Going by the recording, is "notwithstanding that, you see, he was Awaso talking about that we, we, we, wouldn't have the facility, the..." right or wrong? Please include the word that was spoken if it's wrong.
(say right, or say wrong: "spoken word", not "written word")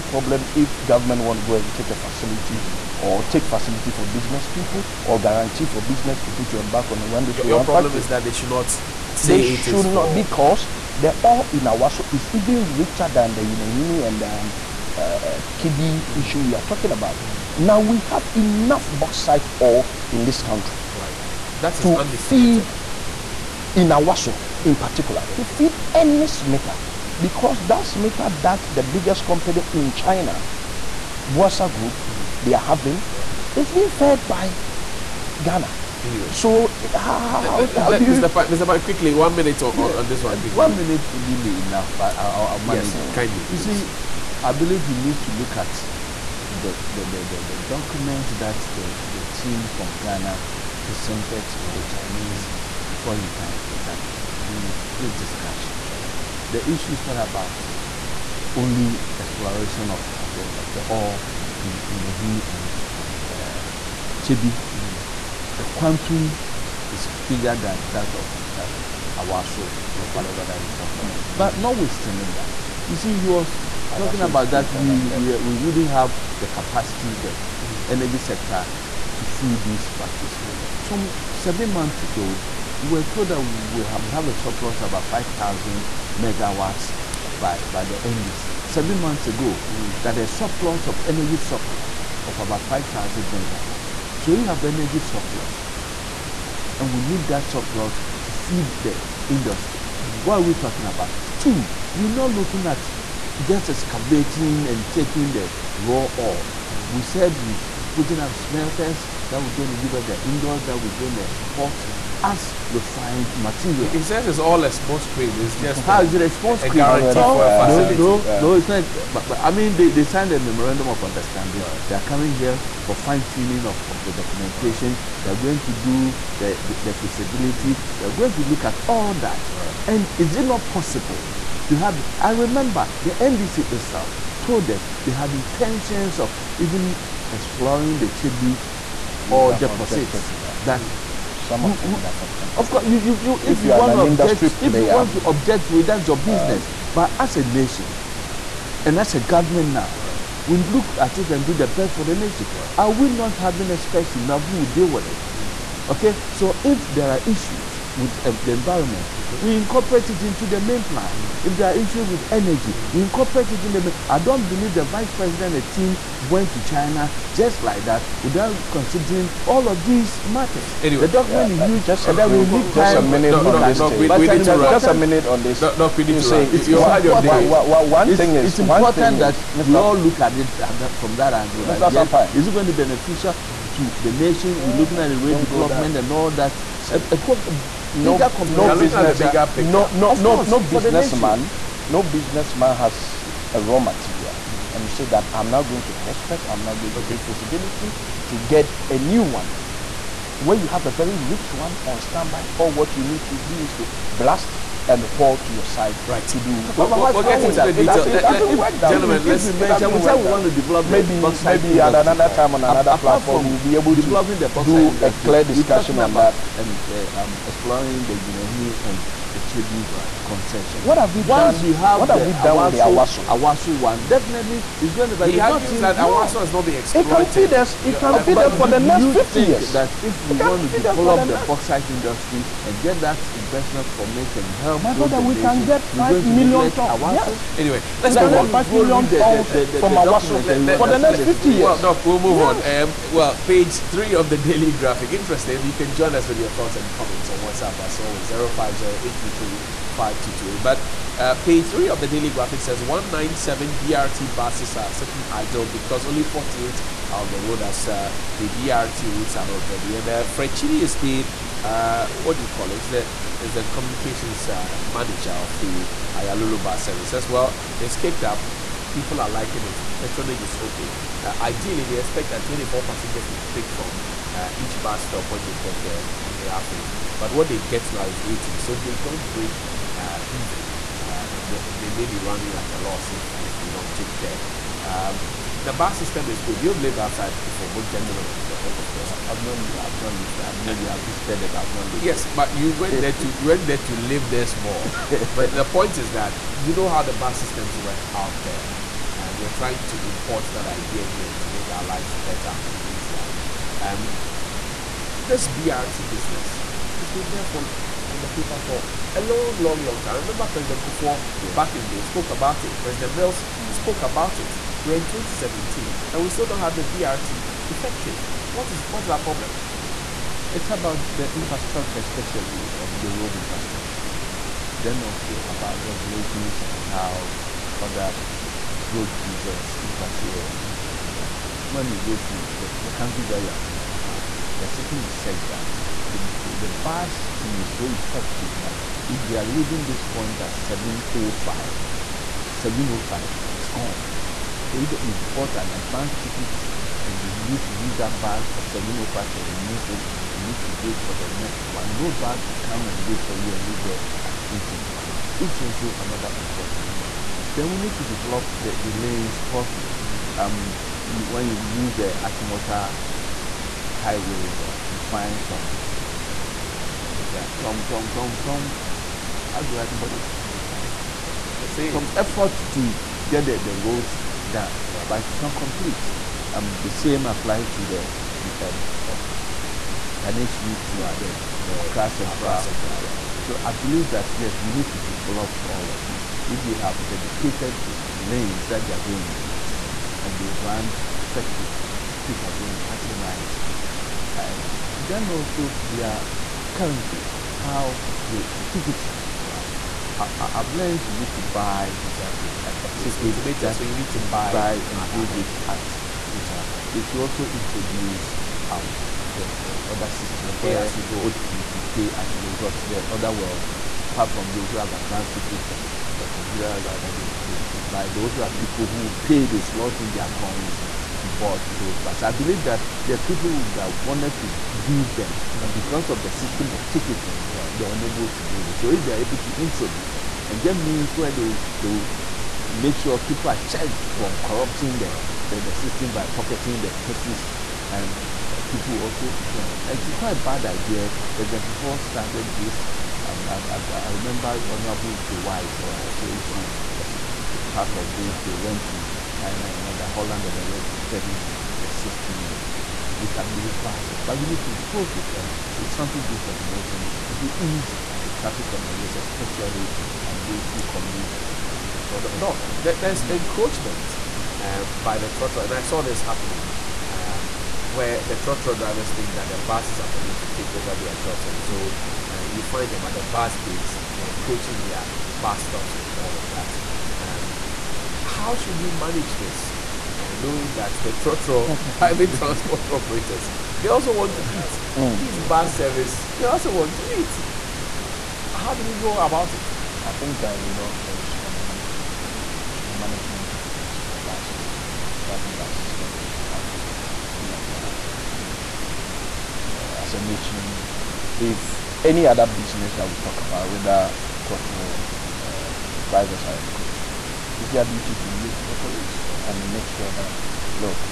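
wrong: "capacity", not "facility".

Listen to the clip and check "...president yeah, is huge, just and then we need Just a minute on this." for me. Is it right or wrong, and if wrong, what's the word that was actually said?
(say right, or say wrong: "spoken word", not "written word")
wrong: "document", not "president".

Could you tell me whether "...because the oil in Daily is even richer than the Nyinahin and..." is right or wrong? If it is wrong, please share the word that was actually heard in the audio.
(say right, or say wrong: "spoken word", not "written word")
wrong: "Awaso", not "Daily".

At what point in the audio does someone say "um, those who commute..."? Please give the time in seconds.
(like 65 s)
460 s.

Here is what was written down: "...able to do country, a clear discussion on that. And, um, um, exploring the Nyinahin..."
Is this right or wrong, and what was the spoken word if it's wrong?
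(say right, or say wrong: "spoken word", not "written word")
wrong: "industry", not "country".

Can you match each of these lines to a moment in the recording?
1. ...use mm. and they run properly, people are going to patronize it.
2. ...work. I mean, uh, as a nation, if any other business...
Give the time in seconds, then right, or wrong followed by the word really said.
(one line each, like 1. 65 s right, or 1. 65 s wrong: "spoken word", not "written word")
1. 389 s wrong: "effectively", not "properly"
2. 497 s right.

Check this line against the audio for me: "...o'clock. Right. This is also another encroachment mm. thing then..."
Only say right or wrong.
wrong.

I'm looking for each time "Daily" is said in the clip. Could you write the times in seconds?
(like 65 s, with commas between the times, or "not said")
244 s, 252 s.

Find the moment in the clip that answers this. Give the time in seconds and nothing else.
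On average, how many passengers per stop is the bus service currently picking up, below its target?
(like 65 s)
278 s.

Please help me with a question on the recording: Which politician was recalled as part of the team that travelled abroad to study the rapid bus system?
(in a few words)
Joe Wise.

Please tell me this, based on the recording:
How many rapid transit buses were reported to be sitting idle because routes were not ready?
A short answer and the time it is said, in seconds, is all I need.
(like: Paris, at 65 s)
197, at 252 s.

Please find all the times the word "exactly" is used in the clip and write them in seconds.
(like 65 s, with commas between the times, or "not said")
367 s, 402 s.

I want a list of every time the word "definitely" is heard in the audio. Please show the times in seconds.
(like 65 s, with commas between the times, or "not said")
224 s.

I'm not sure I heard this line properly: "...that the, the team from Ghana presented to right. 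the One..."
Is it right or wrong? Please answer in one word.
wrong.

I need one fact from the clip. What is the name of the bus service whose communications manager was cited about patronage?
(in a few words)
Aayalolo.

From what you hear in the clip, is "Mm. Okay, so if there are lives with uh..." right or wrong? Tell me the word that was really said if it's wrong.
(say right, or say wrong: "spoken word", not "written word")
wrong: "issues", not "lives".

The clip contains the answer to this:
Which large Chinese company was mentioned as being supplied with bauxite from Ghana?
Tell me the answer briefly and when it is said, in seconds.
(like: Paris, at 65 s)
Bosai Group, at 31 s.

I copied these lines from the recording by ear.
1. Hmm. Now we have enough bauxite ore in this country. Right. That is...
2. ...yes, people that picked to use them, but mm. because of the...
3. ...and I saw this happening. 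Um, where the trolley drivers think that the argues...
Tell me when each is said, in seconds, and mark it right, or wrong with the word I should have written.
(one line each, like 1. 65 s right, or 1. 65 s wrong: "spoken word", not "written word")
1. 17 s right
2. 423 s wrong: "wanted", not "picked"
3. 465 s wrong: "buses", not "argues".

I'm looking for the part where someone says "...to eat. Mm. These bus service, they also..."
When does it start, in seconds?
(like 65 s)
484 s.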